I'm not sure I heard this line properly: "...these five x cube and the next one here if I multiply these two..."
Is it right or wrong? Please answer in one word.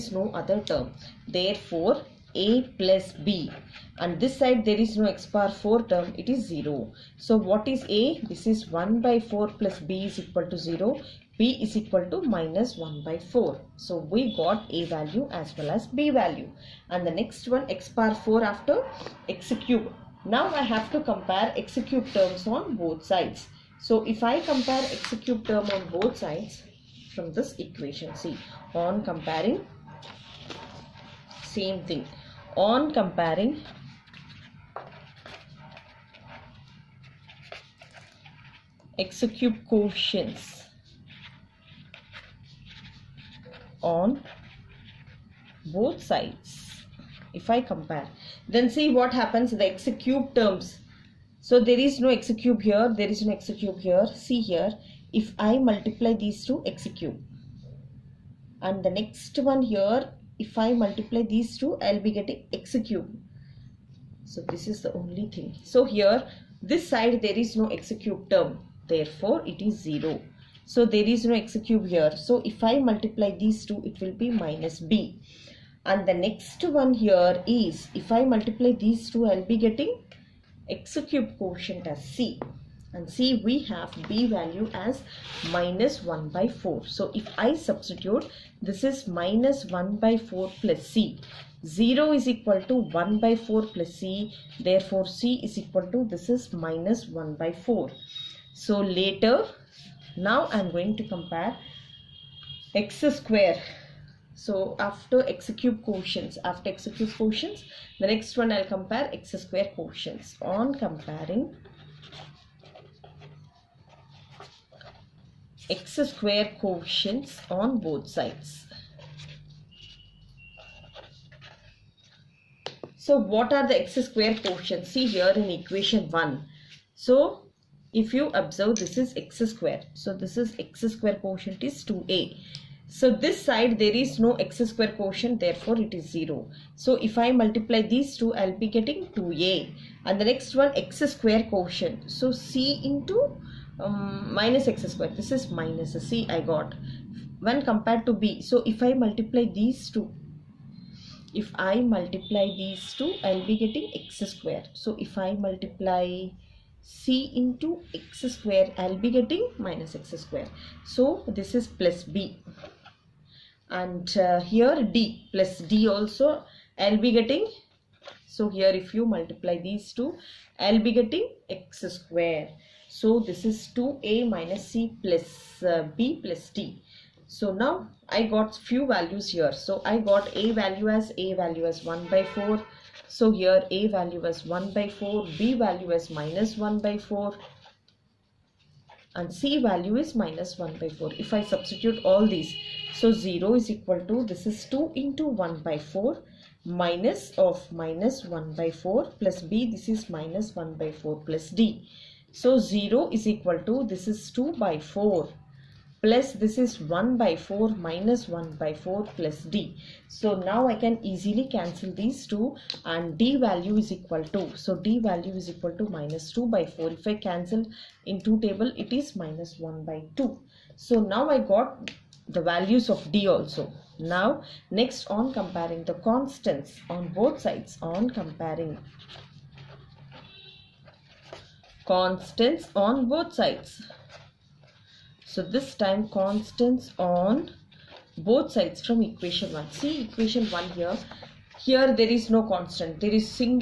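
wrong.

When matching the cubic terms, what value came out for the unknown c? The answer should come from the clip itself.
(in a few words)
-1/4.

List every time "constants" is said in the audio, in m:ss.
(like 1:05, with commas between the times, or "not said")
3:45, 3:51, 3:56, 4:02.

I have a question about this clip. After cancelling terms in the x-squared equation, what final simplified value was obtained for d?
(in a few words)
-1/2.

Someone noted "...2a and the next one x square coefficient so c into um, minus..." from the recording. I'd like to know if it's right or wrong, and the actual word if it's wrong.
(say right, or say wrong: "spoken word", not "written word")
right.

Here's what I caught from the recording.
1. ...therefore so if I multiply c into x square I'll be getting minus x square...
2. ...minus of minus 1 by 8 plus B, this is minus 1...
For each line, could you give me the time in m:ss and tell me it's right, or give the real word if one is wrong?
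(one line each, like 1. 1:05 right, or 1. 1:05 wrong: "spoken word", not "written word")
1. 2:34 wrong: "square", not "therefore"
2. 3:16 wrong: "4", not "8".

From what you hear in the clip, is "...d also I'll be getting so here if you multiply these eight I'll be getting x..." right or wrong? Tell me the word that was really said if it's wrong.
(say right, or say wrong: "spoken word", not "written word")
wrong: "two", not "eight".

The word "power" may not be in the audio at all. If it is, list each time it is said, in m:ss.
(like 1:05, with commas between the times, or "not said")
0:05, 0:17.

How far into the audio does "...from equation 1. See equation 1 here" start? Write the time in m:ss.
3:58.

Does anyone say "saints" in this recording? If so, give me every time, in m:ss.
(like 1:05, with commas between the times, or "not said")
not said.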